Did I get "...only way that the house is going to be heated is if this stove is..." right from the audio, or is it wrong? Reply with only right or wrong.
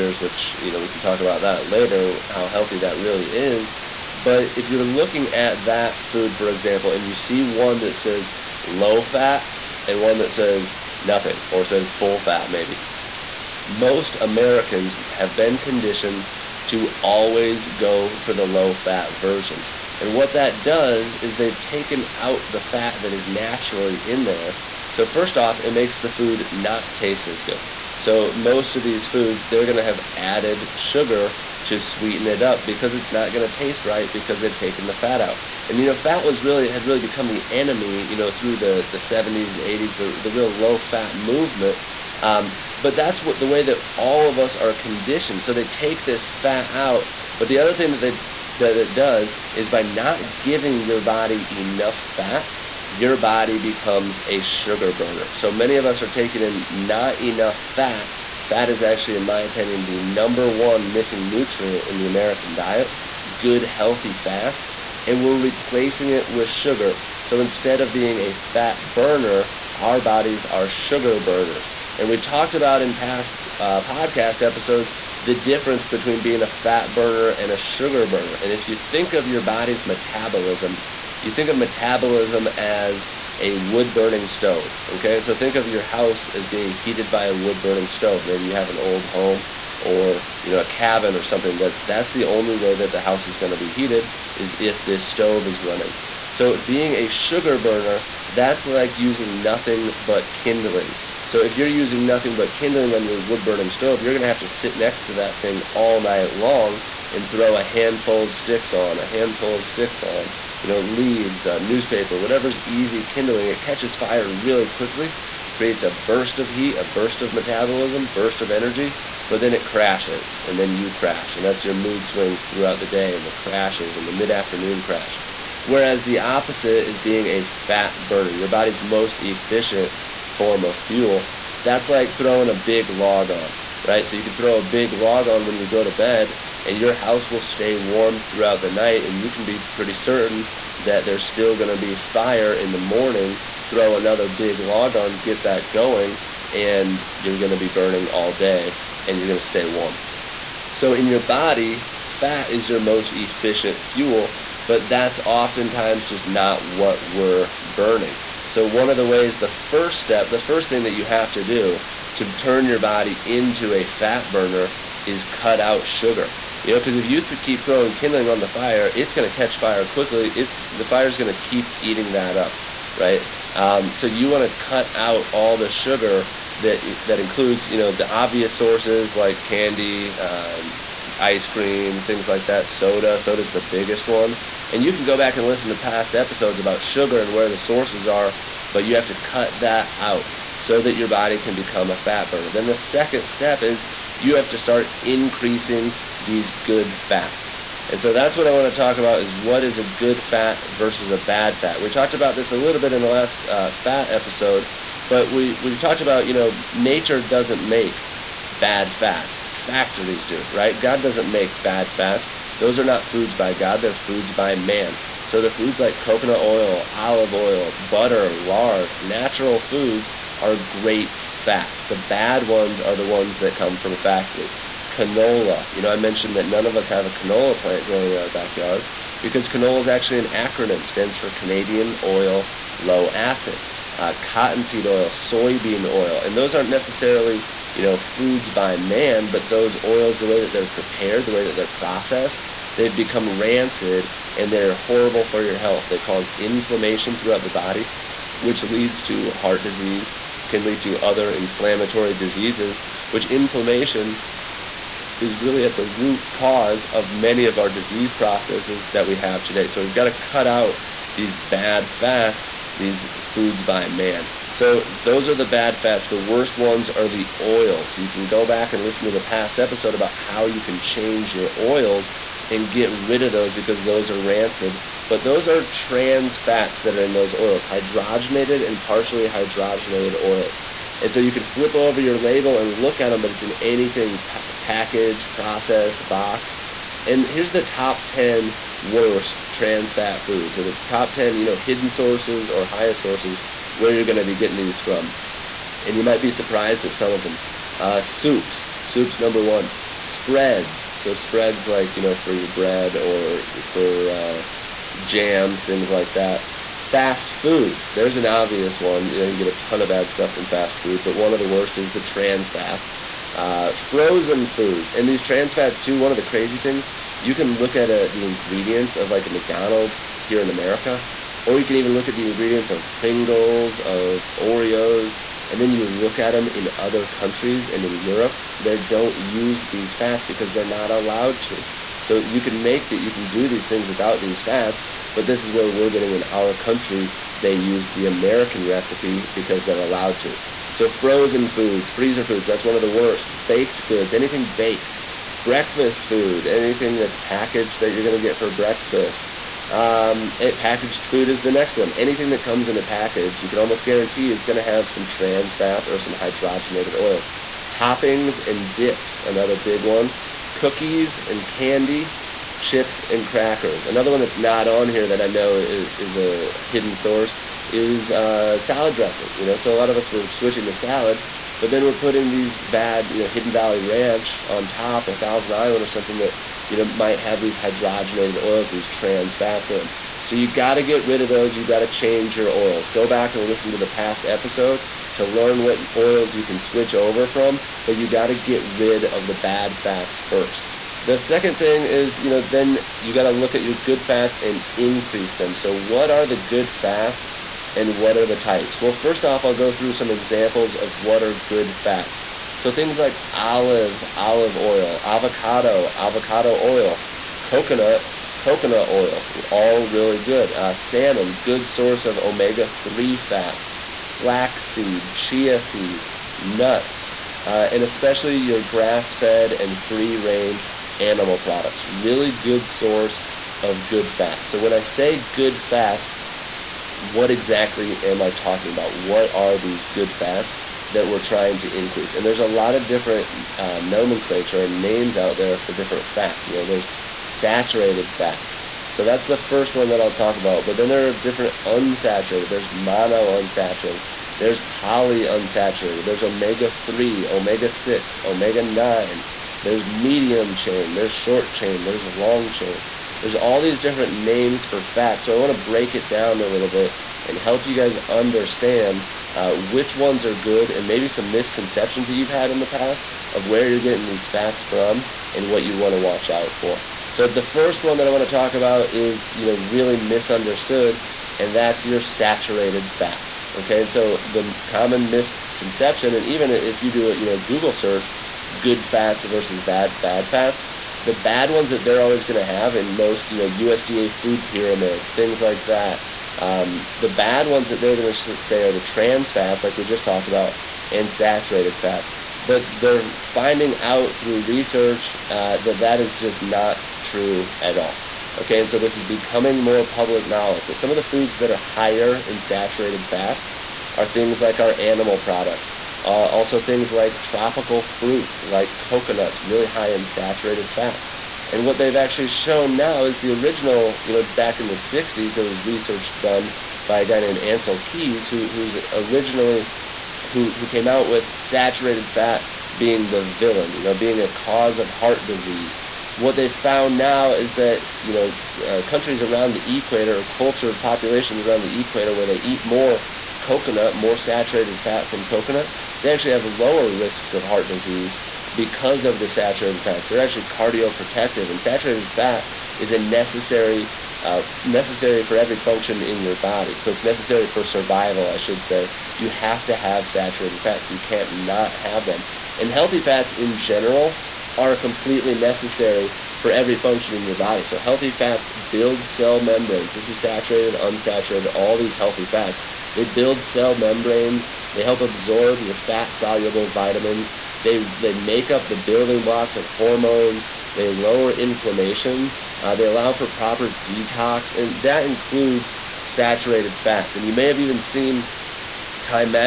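right.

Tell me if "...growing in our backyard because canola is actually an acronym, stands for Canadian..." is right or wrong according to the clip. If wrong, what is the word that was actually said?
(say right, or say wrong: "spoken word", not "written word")
right.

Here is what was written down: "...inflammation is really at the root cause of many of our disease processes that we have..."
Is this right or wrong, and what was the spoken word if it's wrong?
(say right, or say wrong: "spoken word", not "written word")
right.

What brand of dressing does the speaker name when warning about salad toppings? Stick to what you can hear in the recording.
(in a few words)
Hidden Valley Ranch.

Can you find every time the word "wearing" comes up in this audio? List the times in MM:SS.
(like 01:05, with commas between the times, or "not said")
not said.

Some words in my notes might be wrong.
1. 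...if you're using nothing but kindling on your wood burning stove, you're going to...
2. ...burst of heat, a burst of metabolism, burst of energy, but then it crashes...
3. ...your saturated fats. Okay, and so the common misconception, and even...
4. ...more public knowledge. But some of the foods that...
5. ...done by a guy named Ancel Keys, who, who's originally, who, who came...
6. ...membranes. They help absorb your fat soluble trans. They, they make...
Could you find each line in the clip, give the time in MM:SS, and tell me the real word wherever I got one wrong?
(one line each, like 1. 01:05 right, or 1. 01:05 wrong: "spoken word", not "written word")
1. 01:41 right
2. 01:55 right
3. 07:51 right
4. 08:19 right
5. 08:36 right
6. 09:23 wrong: "vitamins", not "trans".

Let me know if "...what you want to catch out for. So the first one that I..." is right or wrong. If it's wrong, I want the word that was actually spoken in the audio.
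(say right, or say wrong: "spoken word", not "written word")
wrong: "watch", not "catch".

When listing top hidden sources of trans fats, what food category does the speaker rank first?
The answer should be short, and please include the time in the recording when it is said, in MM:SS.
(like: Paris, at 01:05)
Soups, at 04:58.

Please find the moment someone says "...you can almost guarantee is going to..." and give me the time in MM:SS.
05:53.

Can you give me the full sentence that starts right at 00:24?
So, first off, it makes the food not taste as good.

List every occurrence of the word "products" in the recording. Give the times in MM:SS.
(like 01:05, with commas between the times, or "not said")
07:01, 08:25.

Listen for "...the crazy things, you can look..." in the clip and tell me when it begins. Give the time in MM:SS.
05:16.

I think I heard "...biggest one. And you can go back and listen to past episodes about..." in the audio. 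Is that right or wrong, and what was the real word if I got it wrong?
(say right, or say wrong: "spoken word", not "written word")
right.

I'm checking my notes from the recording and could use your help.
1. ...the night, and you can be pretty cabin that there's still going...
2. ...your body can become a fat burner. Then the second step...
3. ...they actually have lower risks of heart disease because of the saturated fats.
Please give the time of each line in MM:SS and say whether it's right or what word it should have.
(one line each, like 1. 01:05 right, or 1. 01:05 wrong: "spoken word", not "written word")
1. 02:18 wrong: "certain", not "cabin"
2. 03:10 right
3. 08:55 right.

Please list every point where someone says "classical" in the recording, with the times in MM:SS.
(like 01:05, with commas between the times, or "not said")
not said.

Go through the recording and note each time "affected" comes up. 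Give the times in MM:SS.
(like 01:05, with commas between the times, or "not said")
not said.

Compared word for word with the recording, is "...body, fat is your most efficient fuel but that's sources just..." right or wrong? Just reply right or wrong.
wrong.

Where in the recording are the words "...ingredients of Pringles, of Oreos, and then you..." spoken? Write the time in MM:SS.
05:22.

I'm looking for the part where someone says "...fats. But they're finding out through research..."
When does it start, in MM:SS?
08:11.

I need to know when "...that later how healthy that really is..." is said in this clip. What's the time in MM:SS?
00:01.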